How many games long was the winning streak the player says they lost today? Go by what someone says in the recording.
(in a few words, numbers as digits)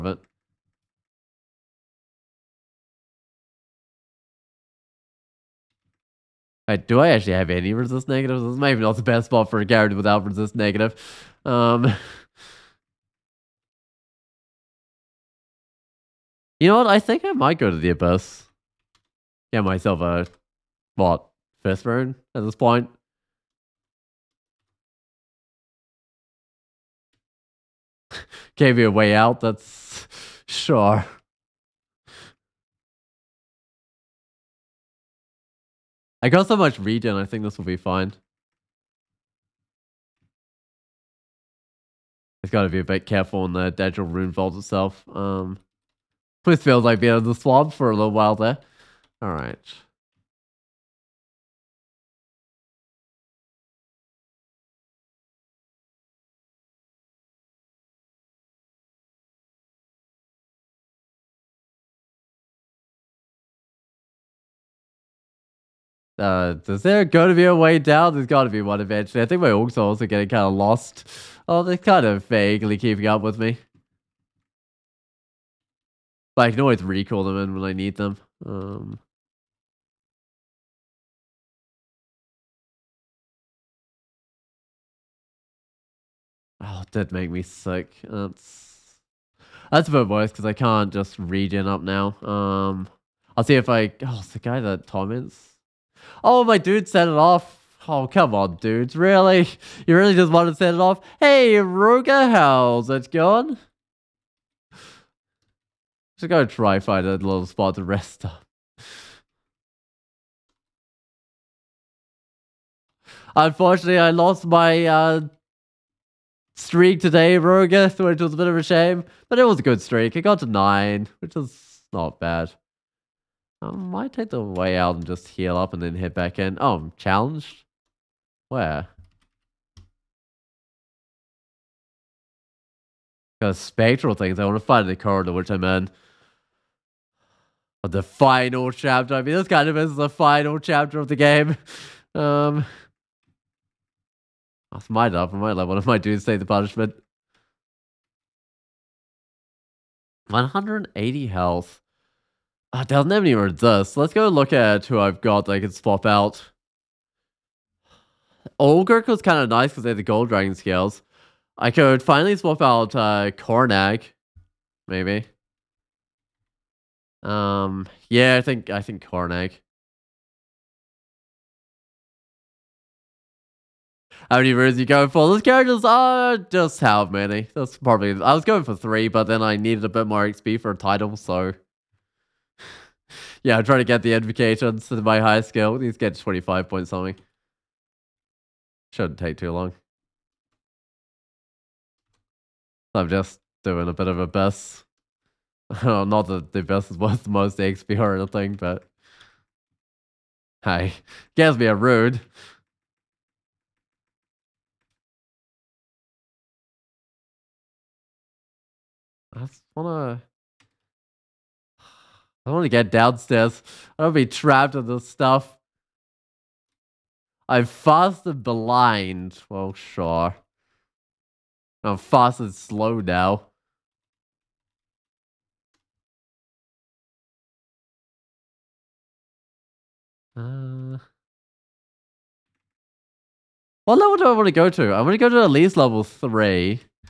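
9.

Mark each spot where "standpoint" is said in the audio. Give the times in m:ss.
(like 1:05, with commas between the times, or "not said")
not said.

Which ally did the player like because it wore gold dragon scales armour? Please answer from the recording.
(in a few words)
Olgurk.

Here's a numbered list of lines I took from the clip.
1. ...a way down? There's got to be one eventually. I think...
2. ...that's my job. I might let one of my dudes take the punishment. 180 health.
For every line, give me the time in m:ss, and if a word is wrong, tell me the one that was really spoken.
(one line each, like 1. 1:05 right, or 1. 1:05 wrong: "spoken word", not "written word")
1. 1:07 right
2. 2:24 right.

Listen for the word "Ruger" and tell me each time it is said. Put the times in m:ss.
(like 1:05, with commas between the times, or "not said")
1:41, 1:57.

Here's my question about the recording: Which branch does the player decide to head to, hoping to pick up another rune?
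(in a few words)
the Abyss.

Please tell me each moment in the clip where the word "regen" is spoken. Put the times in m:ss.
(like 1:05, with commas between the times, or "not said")
0:36, 1:31.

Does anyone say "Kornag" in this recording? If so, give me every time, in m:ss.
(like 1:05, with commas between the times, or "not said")
2:43, 2:49.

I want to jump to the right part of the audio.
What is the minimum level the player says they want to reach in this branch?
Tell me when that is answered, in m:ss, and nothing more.
3:55.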